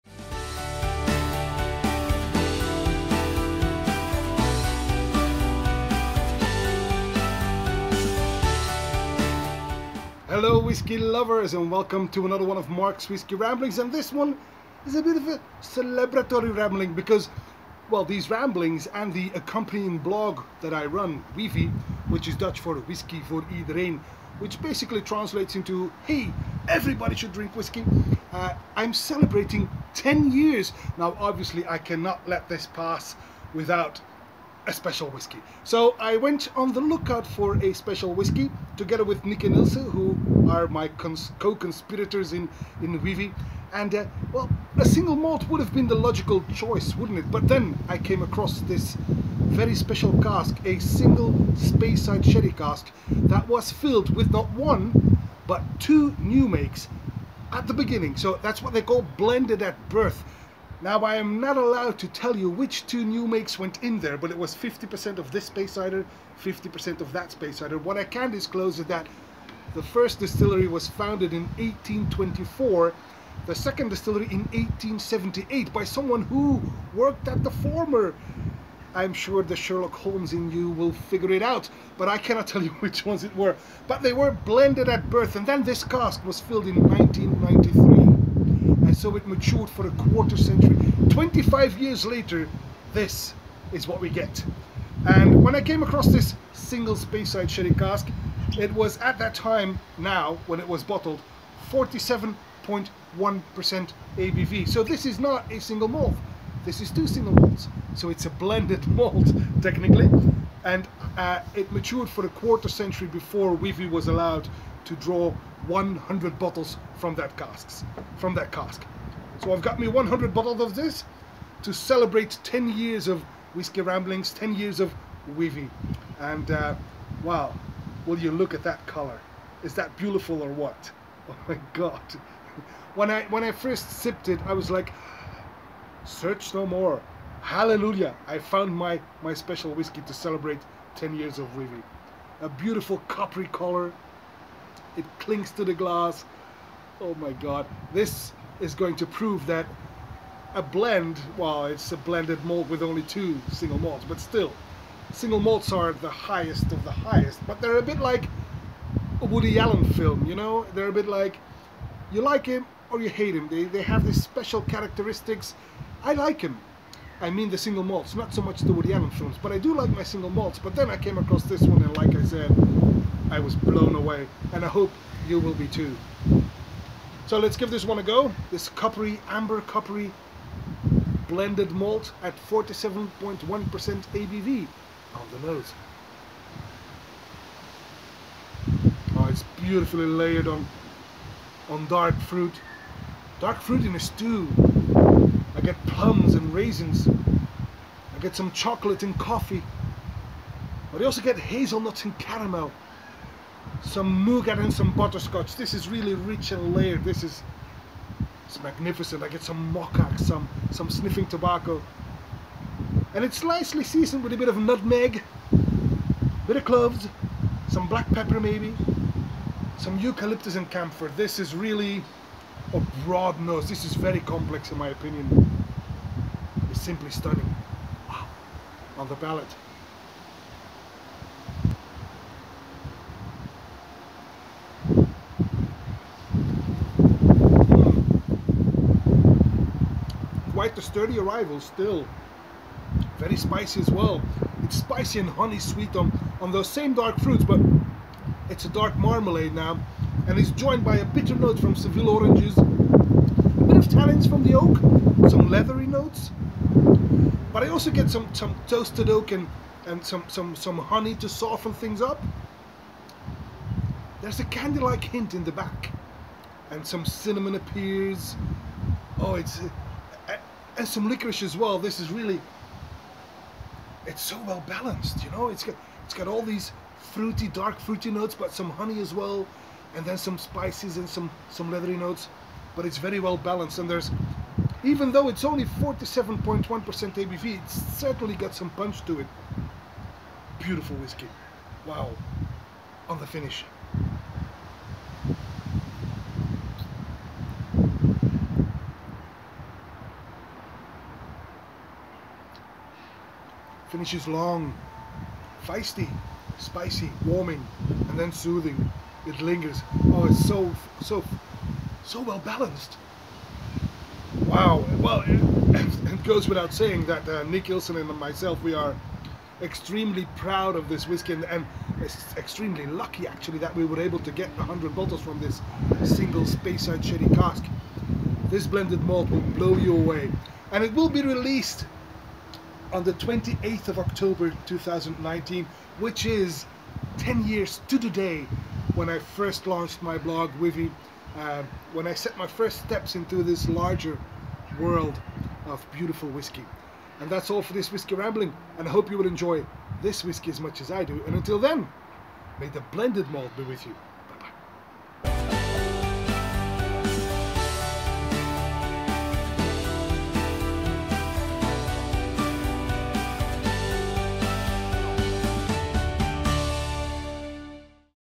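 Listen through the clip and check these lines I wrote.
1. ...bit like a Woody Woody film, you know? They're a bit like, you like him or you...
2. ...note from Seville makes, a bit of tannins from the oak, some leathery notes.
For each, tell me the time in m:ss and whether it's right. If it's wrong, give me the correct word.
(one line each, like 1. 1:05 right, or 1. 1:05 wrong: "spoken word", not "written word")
1. 2:37 wrong: "Allen", not "Woody"
2. 4:11 wrong: "oranges", not "makes".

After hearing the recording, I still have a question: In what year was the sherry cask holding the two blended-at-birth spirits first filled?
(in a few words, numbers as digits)
1993.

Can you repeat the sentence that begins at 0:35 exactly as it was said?
So I went on the lookout for a special whiskey together with Nicky Nilsson who are my co-conspirators in, in Whivie.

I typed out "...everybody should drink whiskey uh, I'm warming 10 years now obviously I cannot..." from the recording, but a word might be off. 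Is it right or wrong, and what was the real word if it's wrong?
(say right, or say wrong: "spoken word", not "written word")
wrong: "celebrating", not "warming".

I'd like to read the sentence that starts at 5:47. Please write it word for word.
And that's all for this Whiskey Rambling, and I hope you will enjoy this whiskey as much as I do.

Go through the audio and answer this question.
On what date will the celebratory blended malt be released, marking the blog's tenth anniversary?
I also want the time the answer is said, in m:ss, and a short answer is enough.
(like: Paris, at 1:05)
28 October 2019, at 5:33.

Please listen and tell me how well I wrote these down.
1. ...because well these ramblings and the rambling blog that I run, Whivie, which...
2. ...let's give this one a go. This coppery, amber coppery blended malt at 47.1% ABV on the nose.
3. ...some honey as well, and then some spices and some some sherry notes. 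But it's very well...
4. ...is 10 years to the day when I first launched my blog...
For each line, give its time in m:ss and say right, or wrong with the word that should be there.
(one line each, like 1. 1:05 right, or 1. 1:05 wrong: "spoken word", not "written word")
1. 0:16 wrong: "accompanying", not "rambling"
2. 2:57 right
3. 4:38 wrong: "leathery", not "sherry"
4. 5:36 right.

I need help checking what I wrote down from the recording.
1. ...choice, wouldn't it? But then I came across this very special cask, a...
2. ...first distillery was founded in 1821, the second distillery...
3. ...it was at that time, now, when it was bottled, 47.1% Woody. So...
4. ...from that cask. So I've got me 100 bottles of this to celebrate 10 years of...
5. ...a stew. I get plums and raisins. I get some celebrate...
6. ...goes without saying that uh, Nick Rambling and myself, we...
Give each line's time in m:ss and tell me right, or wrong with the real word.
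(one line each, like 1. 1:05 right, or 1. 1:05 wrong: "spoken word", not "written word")
1. 0:46 right
2. 1:09 wrong: "1824", not "1821"
3. 1:38 wrong: "ABV", not "Woody"
4. 1:58 right
5. 3:13 wrong: "chocolate", not "celebrate"
6. 5:16 wrong: "Ilson", not "Rambling".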